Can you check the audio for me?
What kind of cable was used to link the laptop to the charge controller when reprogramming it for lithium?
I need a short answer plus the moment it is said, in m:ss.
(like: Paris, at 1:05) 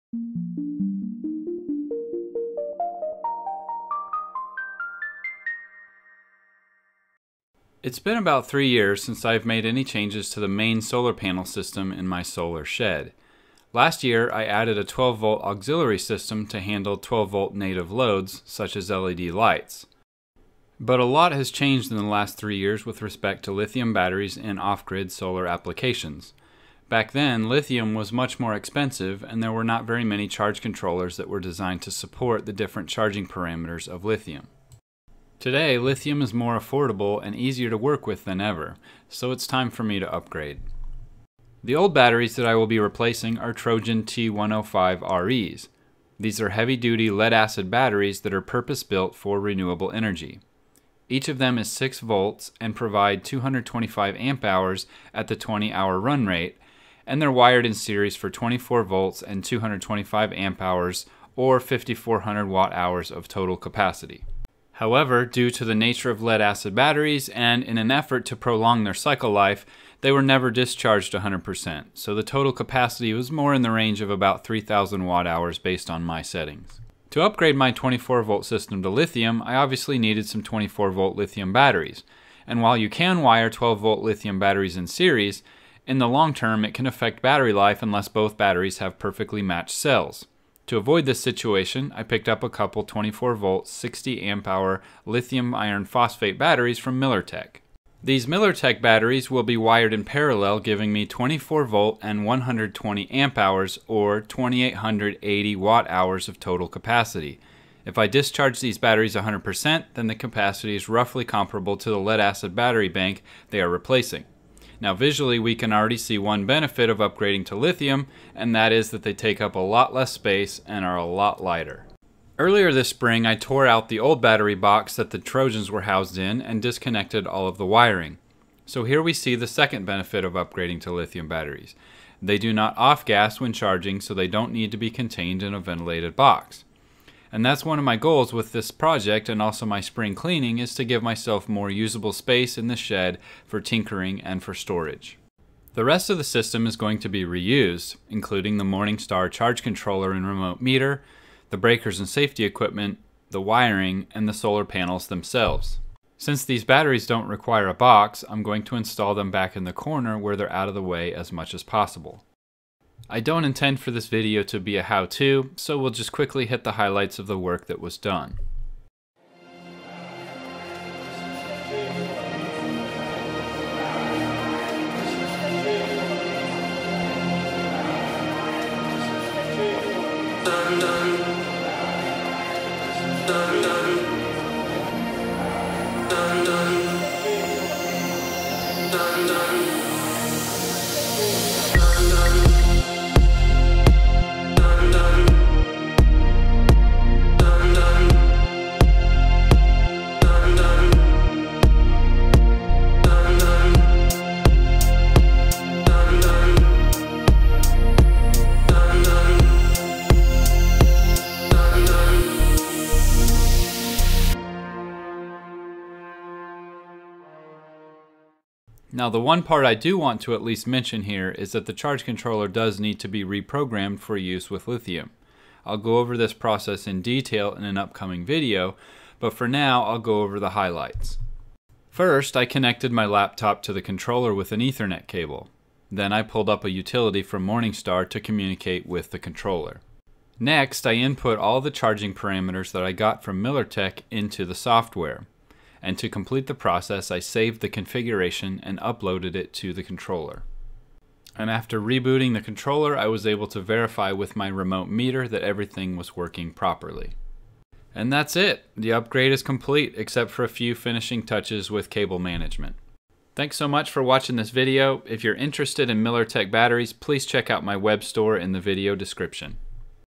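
Ethernet cable, at 3:54.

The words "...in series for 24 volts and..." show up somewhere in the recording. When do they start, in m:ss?
0:57.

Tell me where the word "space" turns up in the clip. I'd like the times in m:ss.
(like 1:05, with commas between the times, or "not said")
2:00, 2:22.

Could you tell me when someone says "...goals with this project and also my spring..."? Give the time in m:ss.
2:17.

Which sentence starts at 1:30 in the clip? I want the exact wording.
To avoid this situation, I picked up a couple 24 volt 60 amp hour lithium iron phosphate batteries from MillerTech.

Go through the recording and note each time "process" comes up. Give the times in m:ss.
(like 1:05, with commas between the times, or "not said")
3:46, 4:06.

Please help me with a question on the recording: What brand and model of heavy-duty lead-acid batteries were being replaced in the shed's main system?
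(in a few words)
Trojan T105RE.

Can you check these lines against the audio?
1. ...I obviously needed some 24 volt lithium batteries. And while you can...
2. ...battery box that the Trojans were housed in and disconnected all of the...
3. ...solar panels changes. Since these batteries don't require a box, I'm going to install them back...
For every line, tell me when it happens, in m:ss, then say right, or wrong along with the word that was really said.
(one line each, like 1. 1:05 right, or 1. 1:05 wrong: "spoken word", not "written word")
1. 1:19 right
2. 2:04 right
3. 2:34 wrong: "themselves", not "changes".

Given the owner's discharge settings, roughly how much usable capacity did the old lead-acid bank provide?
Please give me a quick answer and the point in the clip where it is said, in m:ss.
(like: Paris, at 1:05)
3000 watt hours, at 1:14.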